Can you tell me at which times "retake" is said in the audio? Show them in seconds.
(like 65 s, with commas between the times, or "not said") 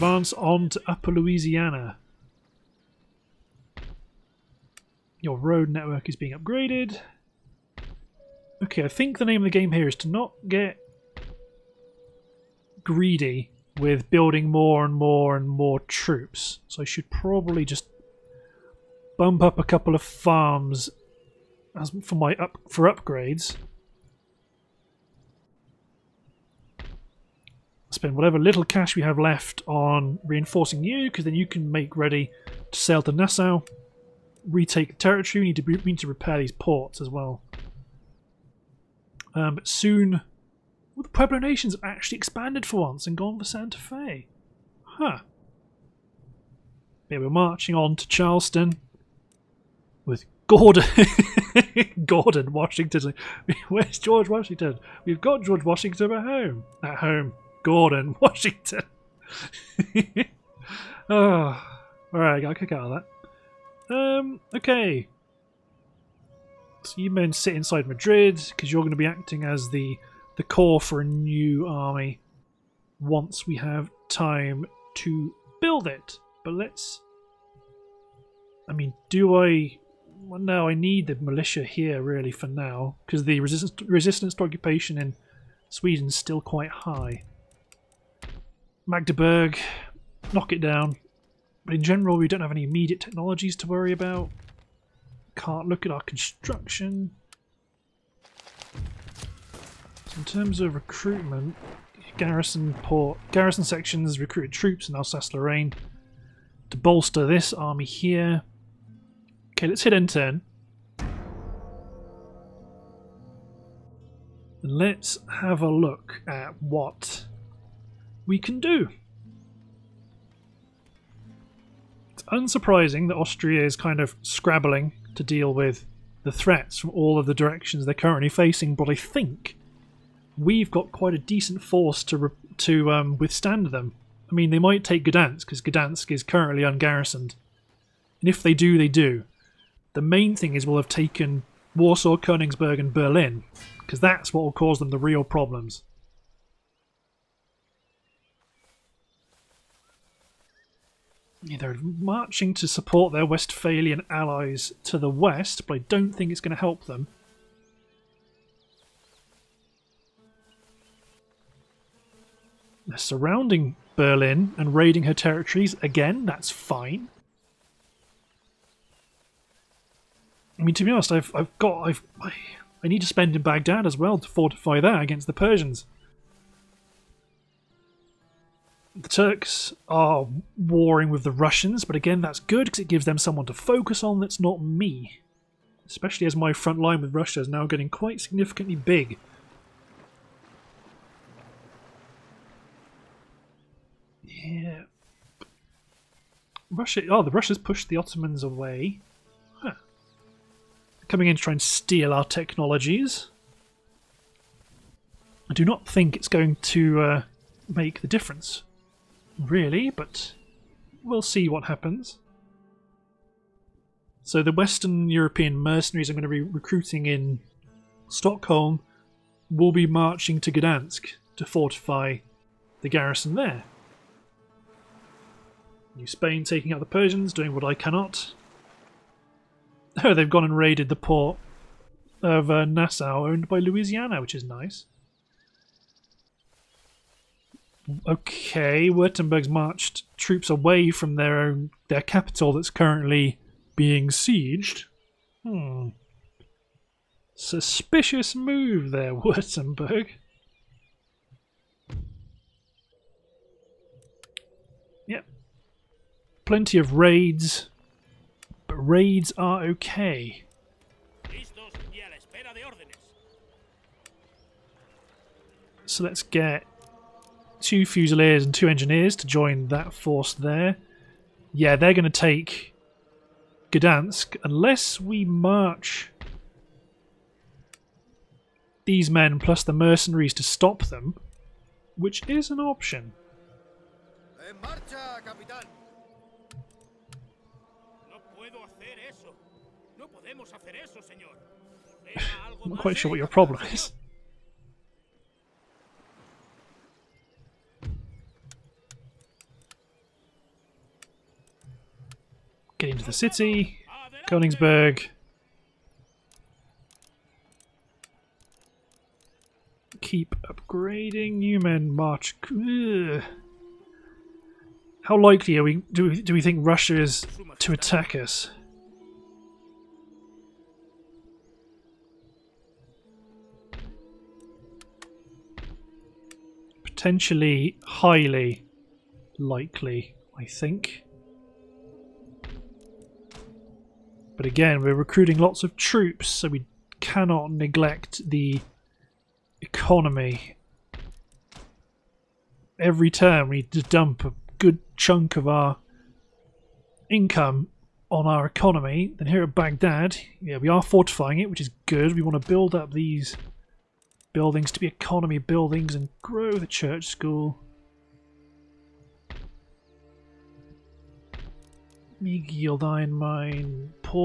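34 s.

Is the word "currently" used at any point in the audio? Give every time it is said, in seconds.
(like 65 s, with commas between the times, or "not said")
127 s, 136 s, 242 s.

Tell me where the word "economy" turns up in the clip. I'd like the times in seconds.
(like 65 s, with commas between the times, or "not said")
339 s, 348 s, 354 s.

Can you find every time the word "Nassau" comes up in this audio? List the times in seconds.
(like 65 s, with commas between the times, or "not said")
33 s, 232 s.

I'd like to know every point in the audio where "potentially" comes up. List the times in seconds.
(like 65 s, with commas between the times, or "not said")
326 s.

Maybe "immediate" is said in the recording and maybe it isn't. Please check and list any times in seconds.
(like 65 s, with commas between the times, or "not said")
92 s.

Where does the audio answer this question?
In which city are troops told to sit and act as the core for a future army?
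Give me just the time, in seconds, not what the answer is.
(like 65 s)
67 s.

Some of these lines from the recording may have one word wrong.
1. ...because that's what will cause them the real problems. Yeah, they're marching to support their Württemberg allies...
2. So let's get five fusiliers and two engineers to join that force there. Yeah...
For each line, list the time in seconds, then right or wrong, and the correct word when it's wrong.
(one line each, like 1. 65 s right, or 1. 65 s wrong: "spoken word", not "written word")
1. 143 s wrong: "Westphalian", not "Württemberg"
2. 265 s wrong: "two", not "five".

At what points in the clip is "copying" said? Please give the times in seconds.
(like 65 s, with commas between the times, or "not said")
not said.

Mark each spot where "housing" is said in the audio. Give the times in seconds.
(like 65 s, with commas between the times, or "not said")
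not said.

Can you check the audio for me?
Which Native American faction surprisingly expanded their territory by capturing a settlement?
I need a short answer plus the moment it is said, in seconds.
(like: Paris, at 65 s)
Pueblo Nations, at 41 s.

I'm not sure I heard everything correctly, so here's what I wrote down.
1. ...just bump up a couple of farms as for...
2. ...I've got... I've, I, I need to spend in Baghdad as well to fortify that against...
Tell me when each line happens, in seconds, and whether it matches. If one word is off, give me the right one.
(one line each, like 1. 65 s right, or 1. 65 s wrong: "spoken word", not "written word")
1. 17 s right
2. 171 s right.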